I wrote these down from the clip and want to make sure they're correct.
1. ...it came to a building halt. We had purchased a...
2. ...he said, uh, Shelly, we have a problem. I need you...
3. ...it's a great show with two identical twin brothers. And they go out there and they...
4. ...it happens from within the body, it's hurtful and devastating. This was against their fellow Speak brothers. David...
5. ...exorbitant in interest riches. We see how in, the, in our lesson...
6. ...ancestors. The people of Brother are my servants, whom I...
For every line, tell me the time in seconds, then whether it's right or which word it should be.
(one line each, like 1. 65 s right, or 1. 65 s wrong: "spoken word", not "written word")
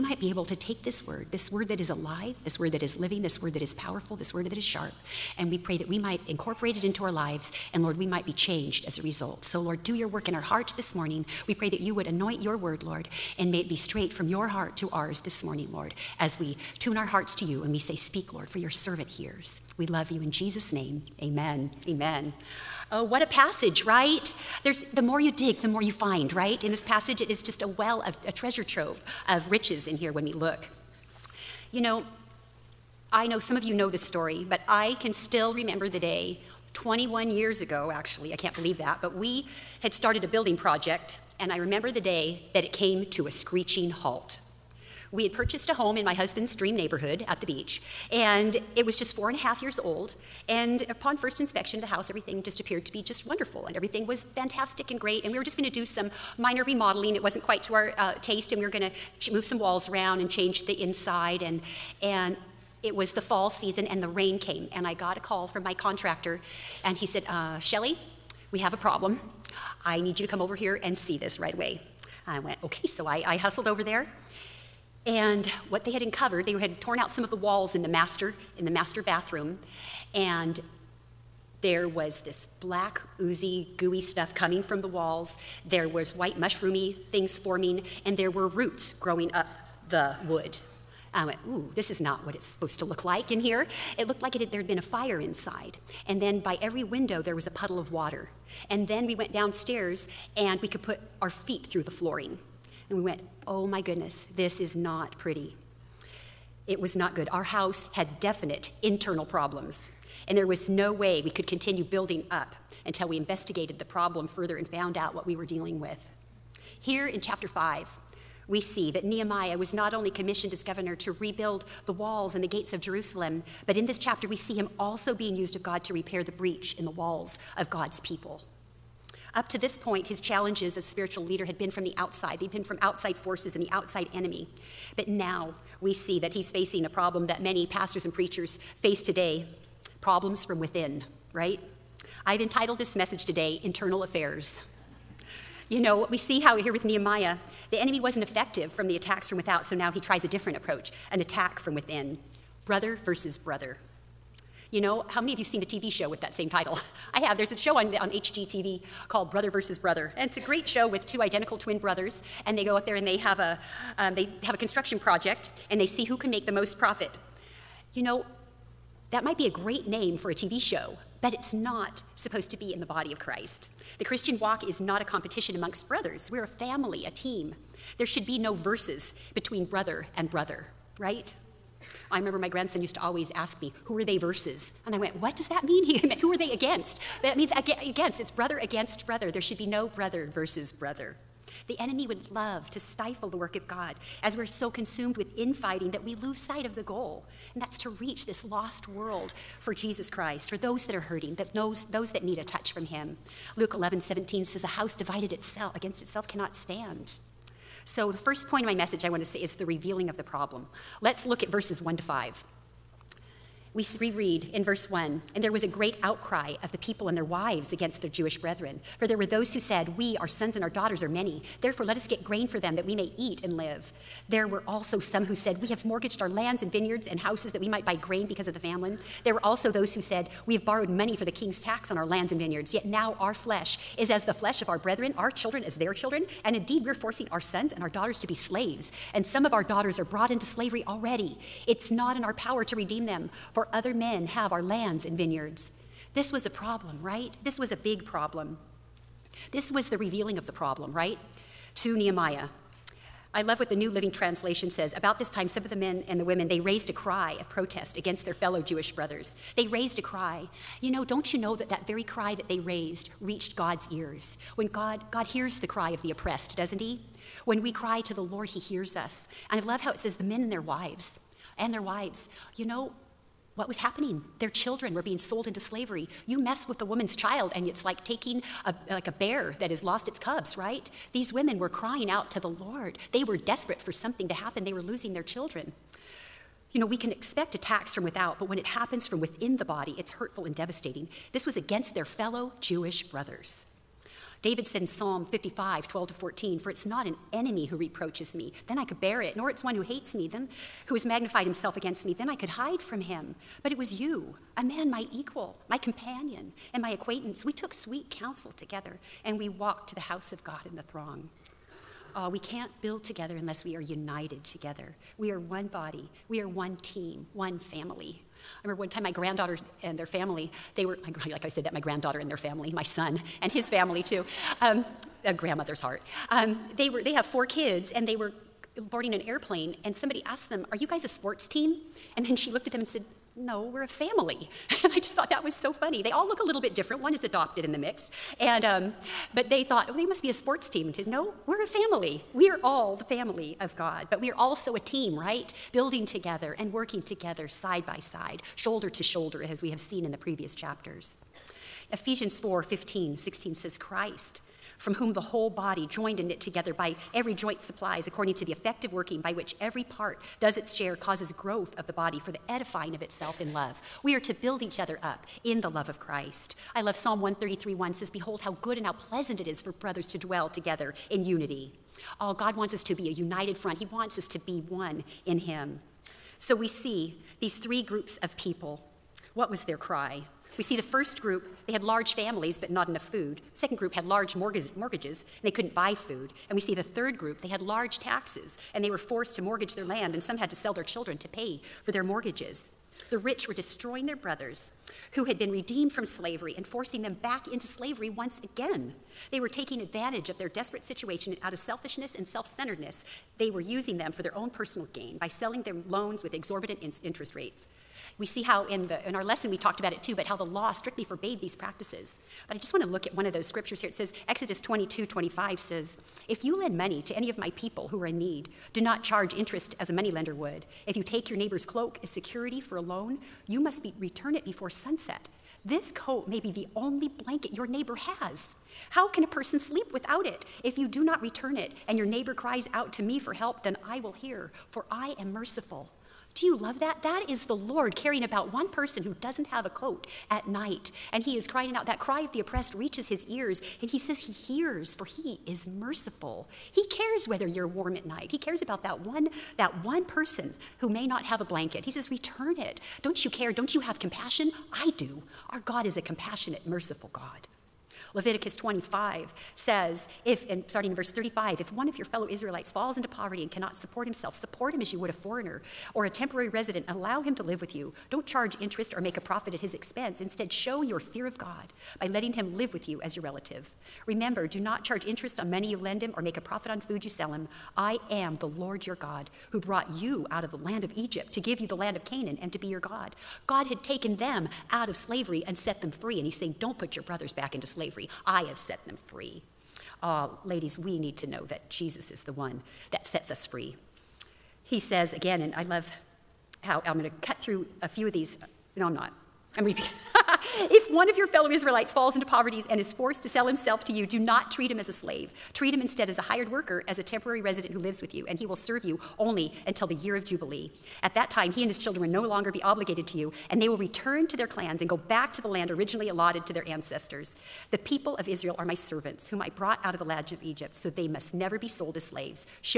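1. 42 s wrong: "screeching", not "building"
2. 66 s right
3. 160 s right
4. 288 s wrong: "Jewish", not "Speak"
5. 406 s wrong: "rates", not "riches"
6. 516 s wrong: "Israel", not "Brother".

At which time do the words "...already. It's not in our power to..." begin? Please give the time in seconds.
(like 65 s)
240 s.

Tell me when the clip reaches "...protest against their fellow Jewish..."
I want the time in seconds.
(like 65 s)
257 s.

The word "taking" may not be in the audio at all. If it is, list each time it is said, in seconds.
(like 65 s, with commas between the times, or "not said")
278 s, 399 s.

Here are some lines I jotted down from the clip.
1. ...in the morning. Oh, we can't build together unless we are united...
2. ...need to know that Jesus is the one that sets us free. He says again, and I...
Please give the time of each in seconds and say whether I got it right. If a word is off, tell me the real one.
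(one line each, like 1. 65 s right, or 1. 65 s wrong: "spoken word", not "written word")
1. 310 s wrong: "throng", not "morning"
2. 490 s right.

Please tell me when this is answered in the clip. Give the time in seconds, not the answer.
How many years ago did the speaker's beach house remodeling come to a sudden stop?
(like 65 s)
36 s.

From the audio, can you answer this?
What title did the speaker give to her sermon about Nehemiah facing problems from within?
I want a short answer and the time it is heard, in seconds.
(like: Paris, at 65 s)
Internal Affairs, at 143 s.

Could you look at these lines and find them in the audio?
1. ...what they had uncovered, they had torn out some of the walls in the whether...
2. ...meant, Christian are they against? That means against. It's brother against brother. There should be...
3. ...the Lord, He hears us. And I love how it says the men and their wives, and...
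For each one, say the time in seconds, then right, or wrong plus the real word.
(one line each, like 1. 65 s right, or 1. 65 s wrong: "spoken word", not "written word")
1. 75 s wrong: "master", not "whether"
2. 186 s wrong: "Who", not "Christian"
3. 268 s right.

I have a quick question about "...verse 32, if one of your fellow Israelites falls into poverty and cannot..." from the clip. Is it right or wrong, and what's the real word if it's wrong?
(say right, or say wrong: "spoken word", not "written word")
wrong: "35", not "32".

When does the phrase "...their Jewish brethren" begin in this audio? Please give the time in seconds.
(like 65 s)
218 s.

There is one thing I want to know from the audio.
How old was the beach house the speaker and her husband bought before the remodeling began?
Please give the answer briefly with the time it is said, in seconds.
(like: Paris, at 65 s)
four and a half years, at 49 s.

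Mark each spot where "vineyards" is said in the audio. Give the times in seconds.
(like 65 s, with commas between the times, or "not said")
226 s, 232 s, 245 s.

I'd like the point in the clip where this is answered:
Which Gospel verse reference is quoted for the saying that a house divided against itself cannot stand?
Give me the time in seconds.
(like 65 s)
203 s.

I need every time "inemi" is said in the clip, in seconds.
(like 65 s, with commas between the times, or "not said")
not said.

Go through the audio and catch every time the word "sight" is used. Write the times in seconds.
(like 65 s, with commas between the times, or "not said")
196 s.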